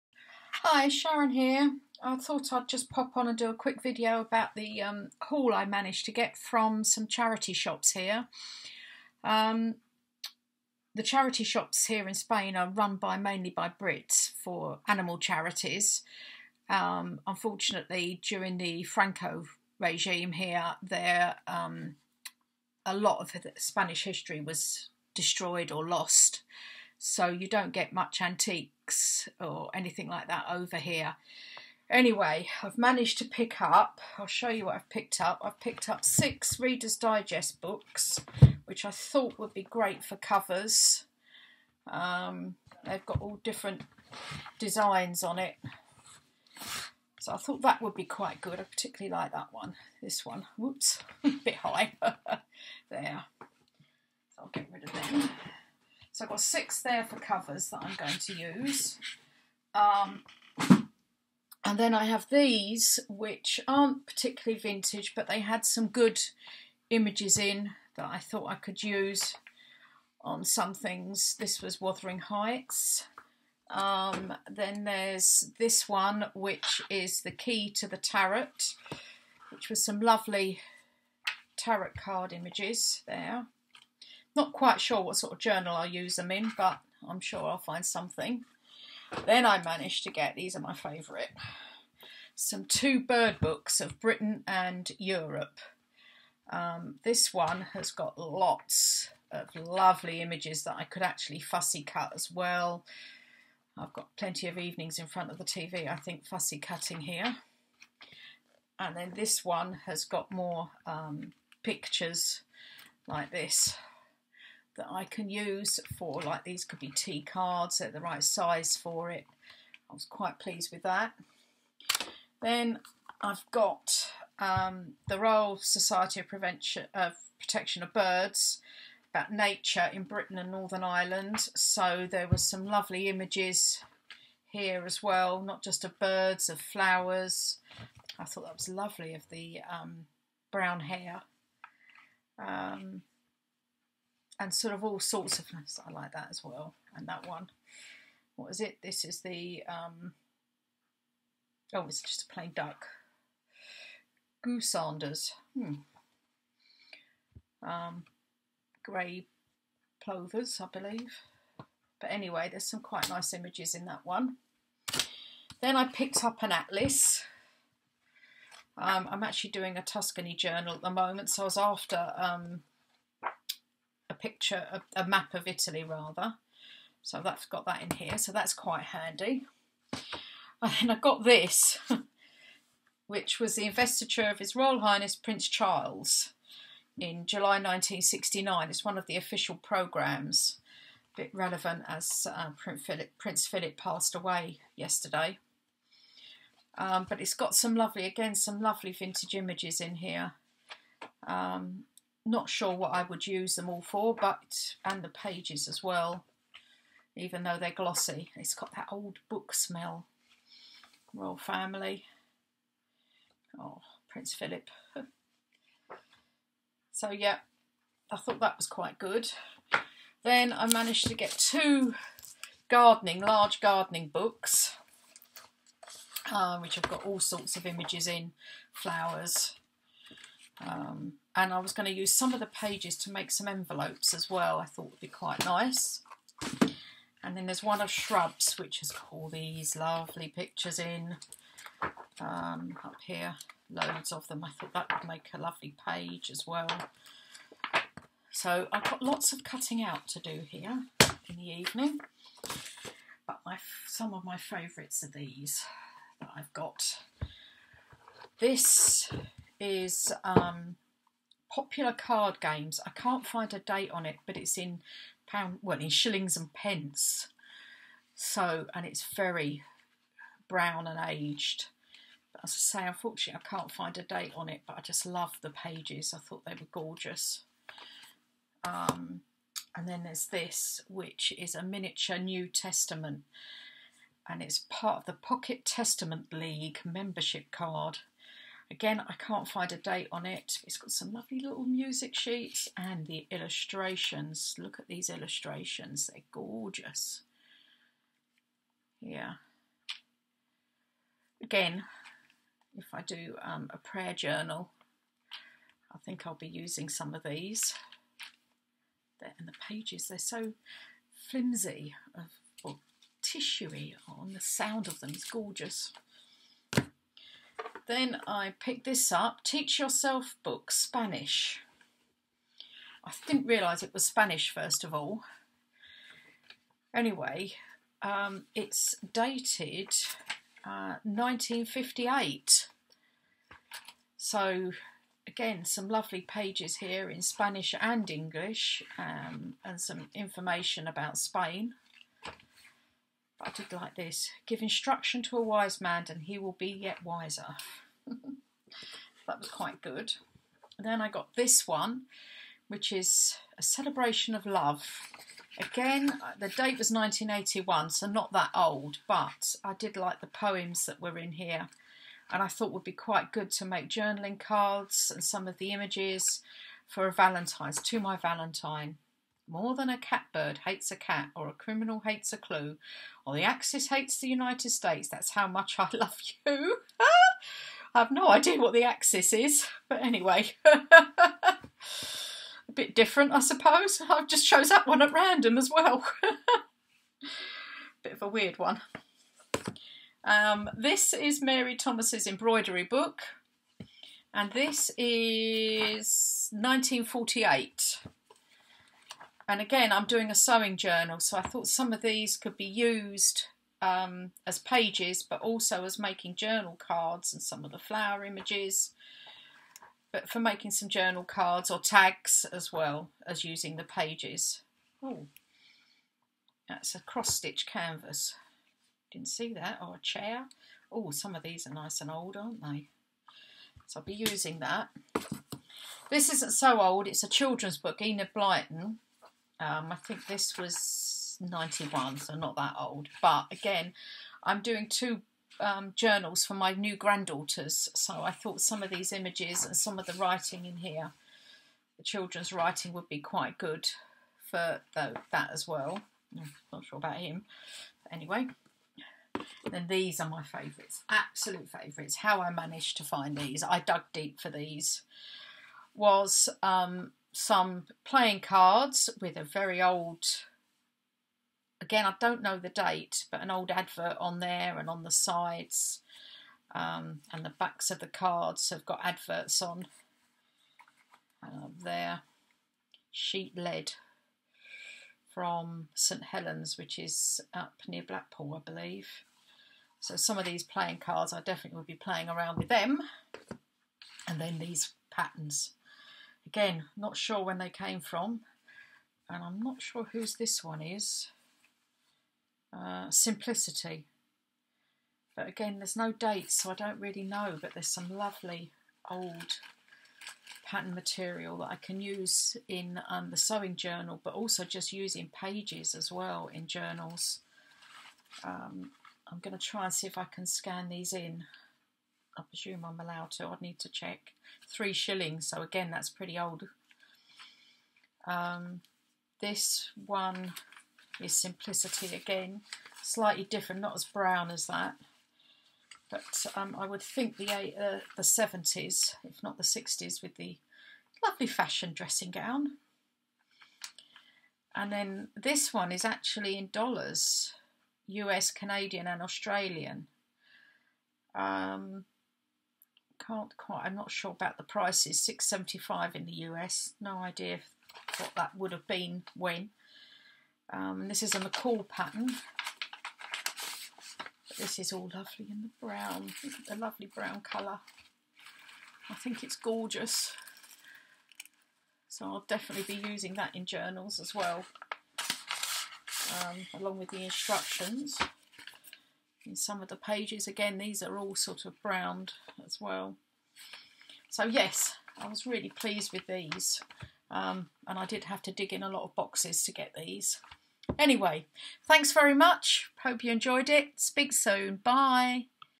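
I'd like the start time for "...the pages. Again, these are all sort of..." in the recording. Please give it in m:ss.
9:29.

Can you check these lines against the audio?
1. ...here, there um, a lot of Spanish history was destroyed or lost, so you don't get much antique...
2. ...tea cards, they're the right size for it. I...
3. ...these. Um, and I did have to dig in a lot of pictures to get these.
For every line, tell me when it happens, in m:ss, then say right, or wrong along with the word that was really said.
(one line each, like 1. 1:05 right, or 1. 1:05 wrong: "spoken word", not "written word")
1. 0:20 right
2. 1:56 right
3. 9:36 wrong: "boxes", not "pictures".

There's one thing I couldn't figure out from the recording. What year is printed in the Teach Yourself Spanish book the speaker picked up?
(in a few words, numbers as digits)
1958.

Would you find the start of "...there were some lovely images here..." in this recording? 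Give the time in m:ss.
2:12.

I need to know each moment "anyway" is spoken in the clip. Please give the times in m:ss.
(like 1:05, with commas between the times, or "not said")
0:31, 2:42, 5:26, 6:20, 7:28, 9:40.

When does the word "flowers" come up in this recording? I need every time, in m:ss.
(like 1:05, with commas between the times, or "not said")
2:16, 3:48, 6:47.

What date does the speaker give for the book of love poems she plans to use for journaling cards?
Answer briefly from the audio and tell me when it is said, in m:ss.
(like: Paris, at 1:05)
1981, at 5:56.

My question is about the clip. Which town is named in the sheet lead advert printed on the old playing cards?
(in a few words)
St Helens.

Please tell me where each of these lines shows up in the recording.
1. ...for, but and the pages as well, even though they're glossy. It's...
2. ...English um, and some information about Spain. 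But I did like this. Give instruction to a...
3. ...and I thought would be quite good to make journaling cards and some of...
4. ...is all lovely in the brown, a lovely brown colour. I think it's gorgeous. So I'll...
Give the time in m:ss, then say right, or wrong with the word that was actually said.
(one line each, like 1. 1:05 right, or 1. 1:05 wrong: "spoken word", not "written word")
1. 3:23 right
2. 5:38 right
3. 6:02 right
4. 9:14 right.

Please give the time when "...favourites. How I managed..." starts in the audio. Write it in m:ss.
7:31.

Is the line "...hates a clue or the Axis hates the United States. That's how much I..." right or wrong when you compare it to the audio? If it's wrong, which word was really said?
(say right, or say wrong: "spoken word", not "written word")
right.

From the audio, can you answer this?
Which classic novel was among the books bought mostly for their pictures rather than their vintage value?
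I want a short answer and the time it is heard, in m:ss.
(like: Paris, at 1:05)
Wuthering Heights, at 1:11.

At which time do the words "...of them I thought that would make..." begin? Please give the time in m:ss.
4:04.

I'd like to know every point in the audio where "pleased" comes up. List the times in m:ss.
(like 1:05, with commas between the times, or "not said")
2:00, 9:35.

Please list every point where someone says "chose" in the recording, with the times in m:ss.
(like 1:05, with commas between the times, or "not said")
6:24.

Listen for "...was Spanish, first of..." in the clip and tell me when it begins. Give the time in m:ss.
5:23.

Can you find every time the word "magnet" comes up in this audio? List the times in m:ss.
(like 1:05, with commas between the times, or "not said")
not said.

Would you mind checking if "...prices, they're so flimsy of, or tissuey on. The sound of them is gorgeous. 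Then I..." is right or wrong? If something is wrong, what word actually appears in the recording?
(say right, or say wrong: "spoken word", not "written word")
wrong: "pages", not "prices".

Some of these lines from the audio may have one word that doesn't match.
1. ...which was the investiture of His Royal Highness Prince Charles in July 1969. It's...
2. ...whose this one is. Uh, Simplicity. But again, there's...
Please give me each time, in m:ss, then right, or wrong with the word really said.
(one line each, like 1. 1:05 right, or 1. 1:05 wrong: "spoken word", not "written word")
1. 3:03 right
2. 8:10 right.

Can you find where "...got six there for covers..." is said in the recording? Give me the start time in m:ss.
0:56.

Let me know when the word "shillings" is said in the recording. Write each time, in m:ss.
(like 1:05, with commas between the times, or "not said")
4:25, 8:34.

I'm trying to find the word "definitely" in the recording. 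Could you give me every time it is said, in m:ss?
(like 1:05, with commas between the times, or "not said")
8:01, 9:22.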